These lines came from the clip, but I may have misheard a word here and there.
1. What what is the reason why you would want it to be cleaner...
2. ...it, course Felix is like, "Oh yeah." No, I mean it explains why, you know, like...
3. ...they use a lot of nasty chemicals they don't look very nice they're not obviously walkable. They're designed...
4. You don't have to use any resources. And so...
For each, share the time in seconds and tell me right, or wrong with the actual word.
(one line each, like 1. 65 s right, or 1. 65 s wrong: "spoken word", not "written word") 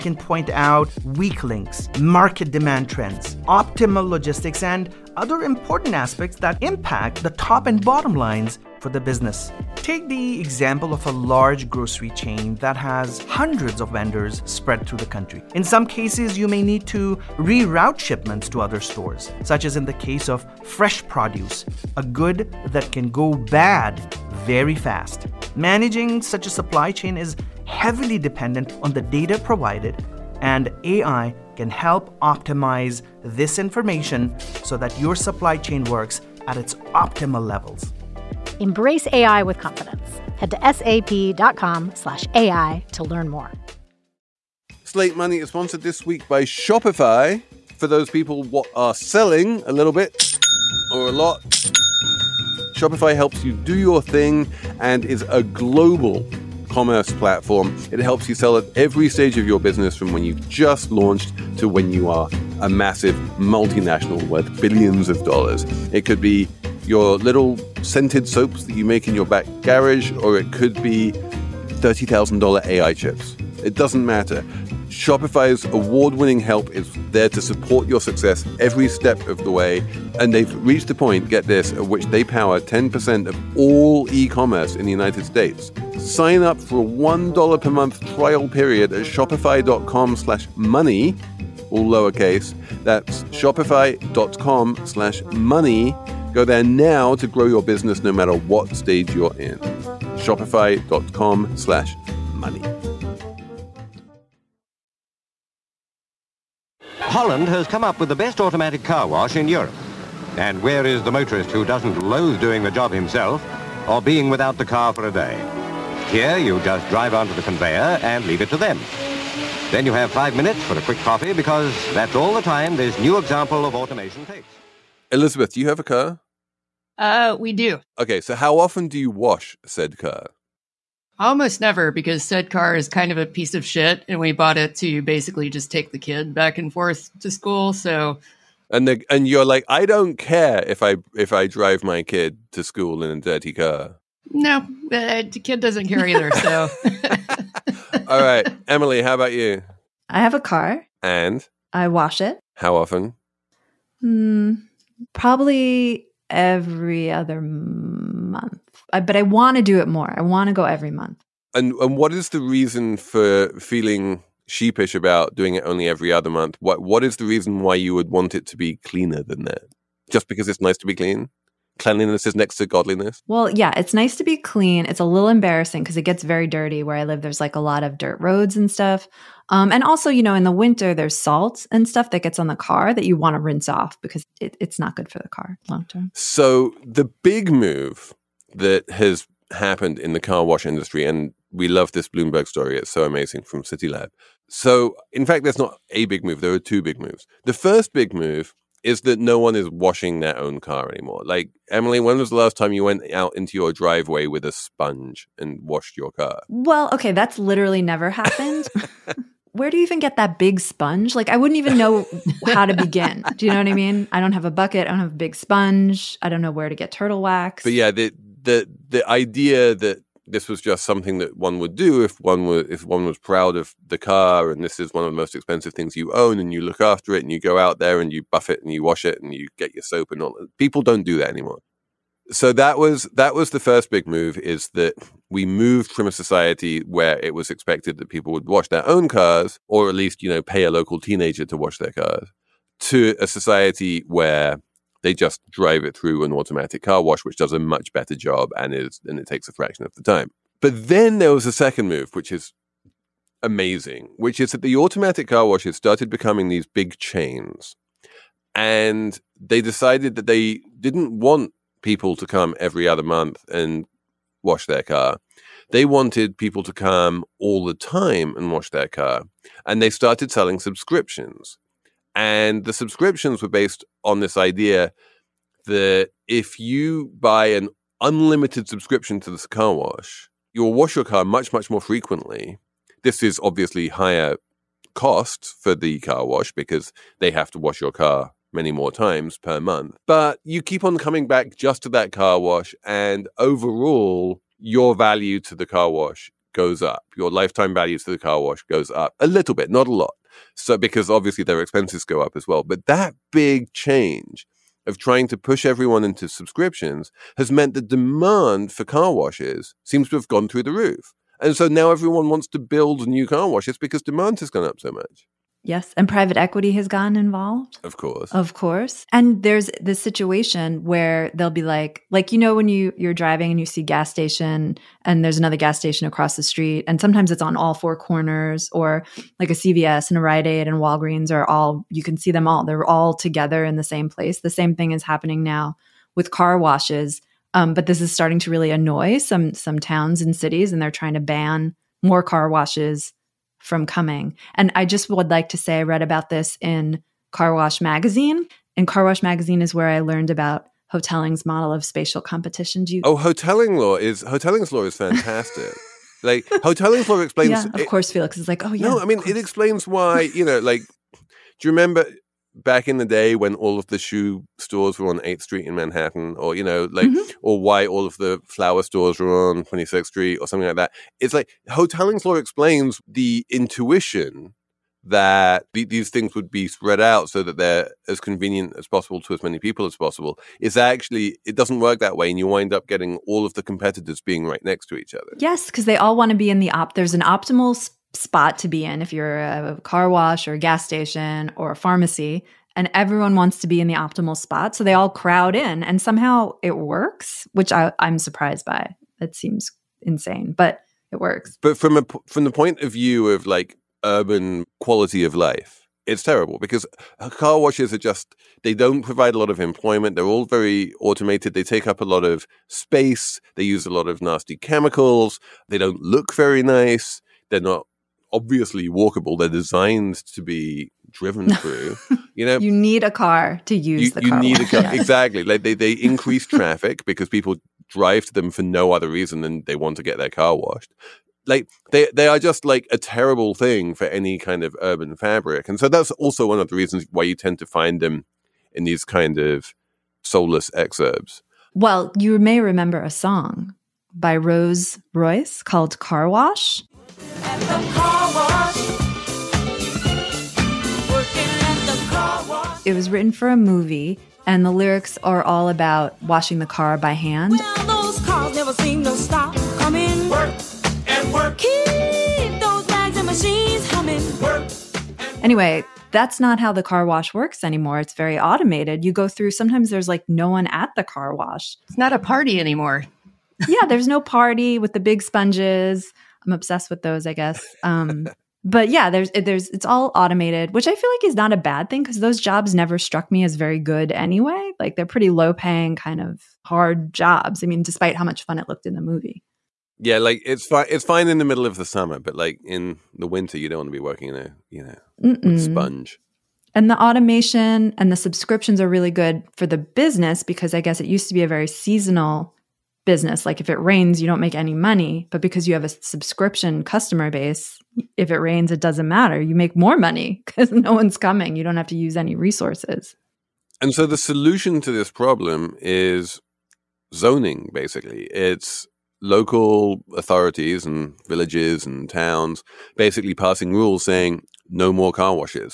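1. 166 s right
2. 357 s right
3. 413 s right
4. 511 s right.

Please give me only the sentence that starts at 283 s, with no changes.
This is obviously higher cost for the car wash because they have to wash your car many more times per month.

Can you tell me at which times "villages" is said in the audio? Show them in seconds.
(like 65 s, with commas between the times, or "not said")
521 s.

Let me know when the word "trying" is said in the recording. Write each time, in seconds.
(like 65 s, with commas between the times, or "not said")
304 s, 340 s.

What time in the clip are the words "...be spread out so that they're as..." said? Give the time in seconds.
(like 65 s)
376 s.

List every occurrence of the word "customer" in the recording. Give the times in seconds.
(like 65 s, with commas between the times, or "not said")
506 s.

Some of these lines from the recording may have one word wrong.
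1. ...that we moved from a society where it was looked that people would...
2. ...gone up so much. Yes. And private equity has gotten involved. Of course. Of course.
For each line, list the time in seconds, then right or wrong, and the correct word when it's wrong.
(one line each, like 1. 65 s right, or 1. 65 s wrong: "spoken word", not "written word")
1. 234 s wrong: "expected", not "looked"
2. 314 s right.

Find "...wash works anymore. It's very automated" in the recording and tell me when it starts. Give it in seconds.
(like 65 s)
467 s.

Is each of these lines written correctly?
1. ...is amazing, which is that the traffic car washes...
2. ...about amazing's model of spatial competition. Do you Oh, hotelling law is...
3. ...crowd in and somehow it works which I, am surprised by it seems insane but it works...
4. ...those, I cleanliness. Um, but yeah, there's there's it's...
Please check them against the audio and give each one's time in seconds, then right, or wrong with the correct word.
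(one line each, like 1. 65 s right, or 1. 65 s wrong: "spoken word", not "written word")
1. 252 s wrong: "automatic", not "traffic"
2. 350 s wrong: "hotelling", not "amazing"
3. 395 s right
4. 477 s wrong: "guess", not "cleanliness".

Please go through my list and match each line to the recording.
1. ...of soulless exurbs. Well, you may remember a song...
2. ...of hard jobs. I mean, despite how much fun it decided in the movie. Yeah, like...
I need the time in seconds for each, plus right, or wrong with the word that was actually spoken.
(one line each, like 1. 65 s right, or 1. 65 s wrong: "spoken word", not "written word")
1. 439 s right
2. 486 s wrong: "looked", not "decided".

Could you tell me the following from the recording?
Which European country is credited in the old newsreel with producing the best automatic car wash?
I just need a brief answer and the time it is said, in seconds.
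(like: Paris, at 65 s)
Holland, at 106 s.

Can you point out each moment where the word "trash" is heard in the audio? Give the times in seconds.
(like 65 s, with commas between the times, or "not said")
not said.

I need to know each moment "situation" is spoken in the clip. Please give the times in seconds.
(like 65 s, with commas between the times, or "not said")
319 s.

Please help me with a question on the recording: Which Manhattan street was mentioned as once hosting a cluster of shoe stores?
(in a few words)
8th Street.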